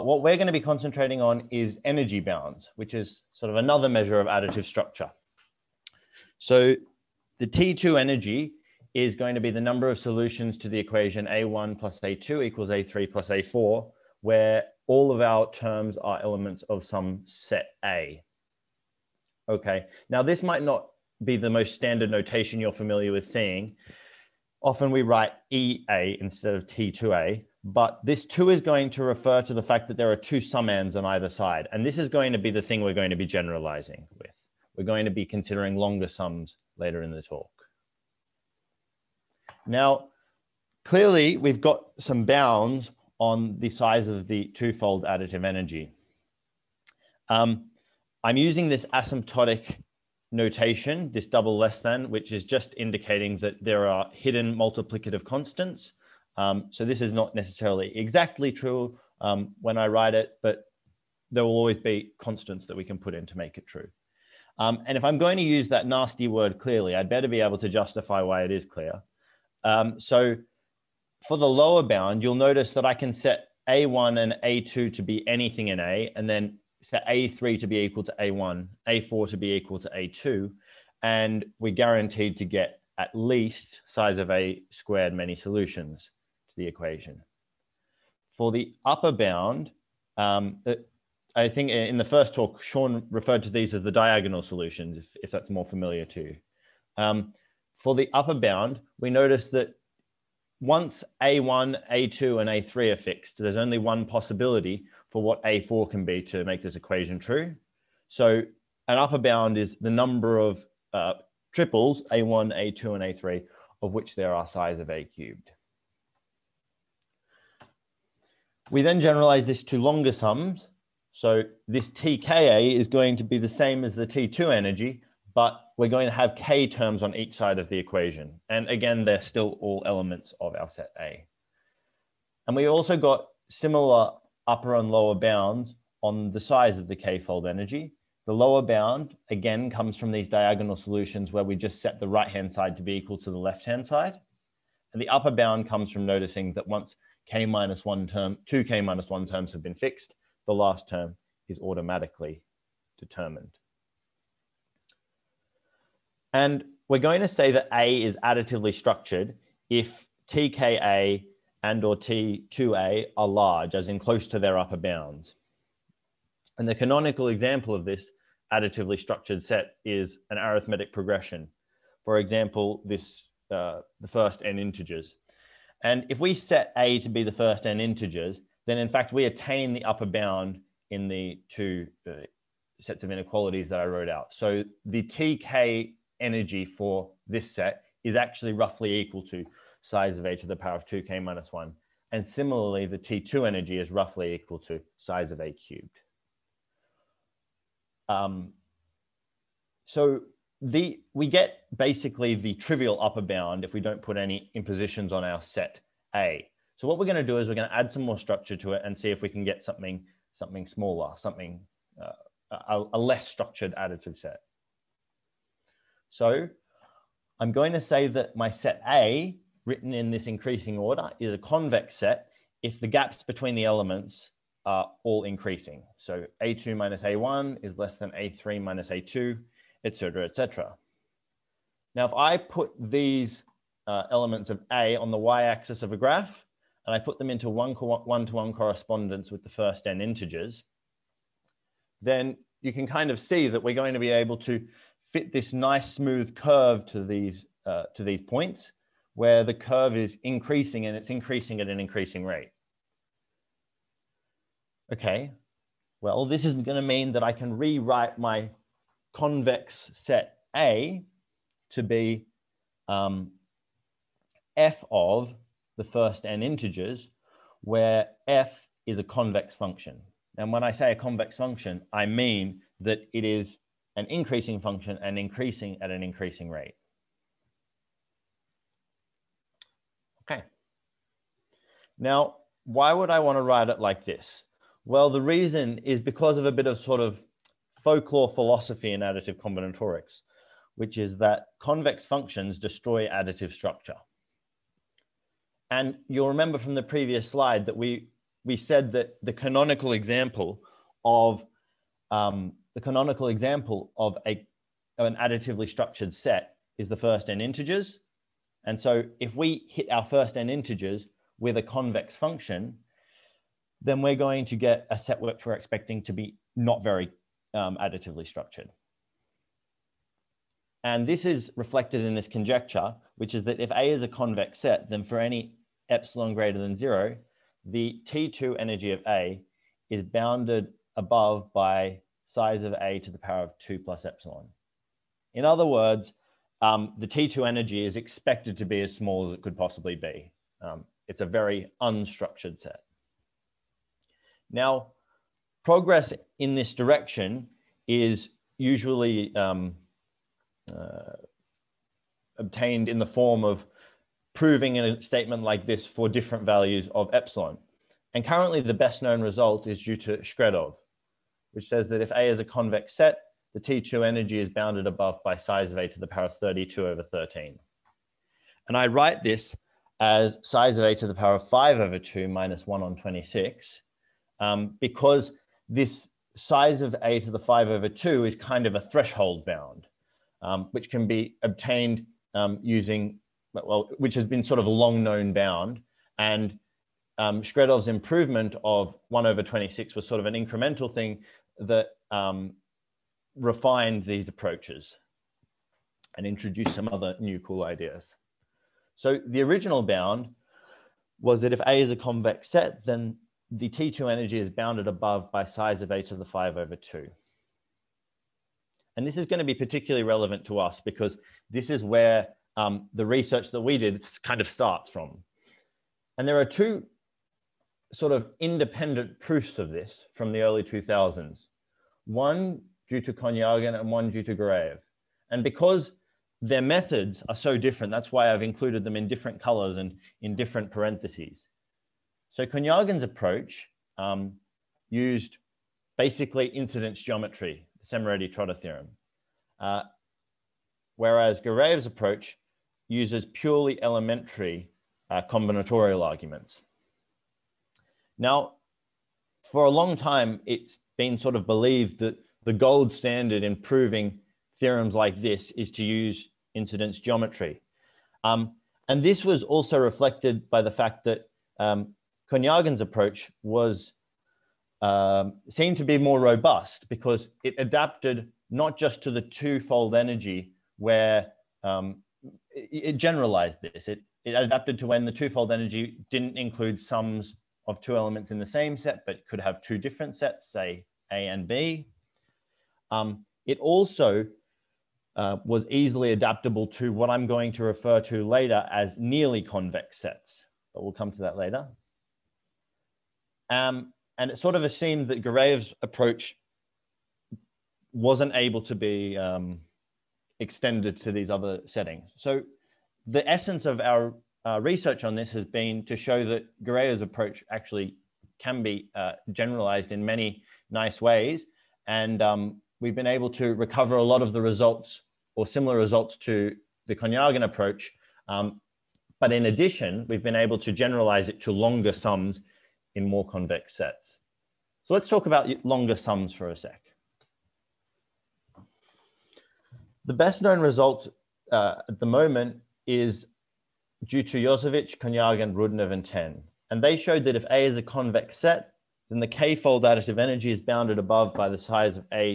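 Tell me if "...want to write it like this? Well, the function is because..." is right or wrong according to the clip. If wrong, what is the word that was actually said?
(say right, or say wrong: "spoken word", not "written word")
wrong: "reason", not "function".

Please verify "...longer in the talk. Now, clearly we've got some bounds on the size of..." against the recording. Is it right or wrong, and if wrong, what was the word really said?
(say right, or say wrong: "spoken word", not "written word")
wrong: "later", not "longer".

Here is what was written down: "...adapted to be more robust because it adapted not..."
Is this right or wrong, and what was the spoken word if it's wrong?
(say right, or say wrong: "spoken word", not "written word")
wrong: "seemed", not "adapted".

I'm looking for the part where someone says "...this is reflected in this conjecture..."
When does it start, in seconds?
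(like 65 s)
321 s.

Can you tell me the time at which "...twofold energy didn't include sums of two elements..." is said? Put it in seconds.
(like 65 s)
475 s.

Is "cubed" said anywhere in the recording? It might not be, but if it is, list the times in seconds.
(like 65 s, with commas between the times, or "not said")
115 s, 195 s.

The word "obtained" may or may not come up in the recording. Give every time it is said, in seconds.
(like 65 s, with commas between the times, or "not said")
352 s, 381 s.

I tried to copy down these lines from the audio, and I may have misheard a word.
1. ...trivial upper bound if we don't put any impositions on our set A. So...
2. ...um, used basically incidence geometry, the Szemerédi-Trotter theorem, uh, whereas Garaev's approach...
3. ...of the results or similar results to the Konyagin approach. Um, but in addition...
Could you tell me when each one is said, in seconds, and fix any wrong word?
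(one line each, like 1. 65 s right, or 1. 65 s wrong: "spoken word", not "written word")
1. 202 s right
2. 433 s right
3. 514 s right.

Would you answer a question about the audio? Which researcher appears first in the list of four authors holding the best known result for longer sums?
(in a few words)
Iosevich.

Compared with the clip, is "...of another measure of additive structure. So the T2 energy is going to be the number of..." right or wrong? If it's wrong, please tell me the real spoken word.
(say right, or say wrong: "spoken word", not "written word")
right.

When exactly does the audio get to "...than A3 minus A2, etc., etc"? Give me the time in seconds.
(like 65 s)
227 s.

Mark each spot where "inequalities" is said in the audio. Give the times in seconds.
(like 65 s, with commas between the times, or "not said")
183 s.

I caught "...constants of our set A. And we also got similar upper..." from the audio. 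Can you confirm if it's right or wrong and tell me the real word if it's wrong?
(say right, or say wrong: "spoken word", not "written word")
wrong: "elements", not "constants".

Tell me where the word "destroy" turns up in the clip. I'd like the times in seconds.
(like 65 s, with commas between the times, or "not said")
292 s.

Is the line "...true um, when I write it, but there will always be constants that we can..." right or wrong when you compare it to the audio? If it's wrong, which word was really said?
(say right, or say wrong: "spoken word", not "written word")
right.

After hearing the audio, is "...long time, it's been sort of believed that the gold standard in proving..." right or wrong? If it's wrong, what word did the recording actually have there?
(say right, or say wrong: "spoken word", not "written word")
right.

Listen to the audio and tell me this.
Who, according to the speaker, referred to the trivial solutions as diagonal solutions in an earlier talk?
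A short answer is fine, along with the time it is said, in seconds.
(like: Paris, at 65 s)
Sean, at 92 s.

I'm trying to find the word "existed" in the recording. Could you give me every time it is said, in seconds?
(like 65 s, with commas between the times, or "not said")
not said.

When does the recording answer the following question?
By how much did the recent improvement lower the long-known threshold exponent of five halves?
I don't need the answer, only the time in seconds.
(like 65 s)
372 s.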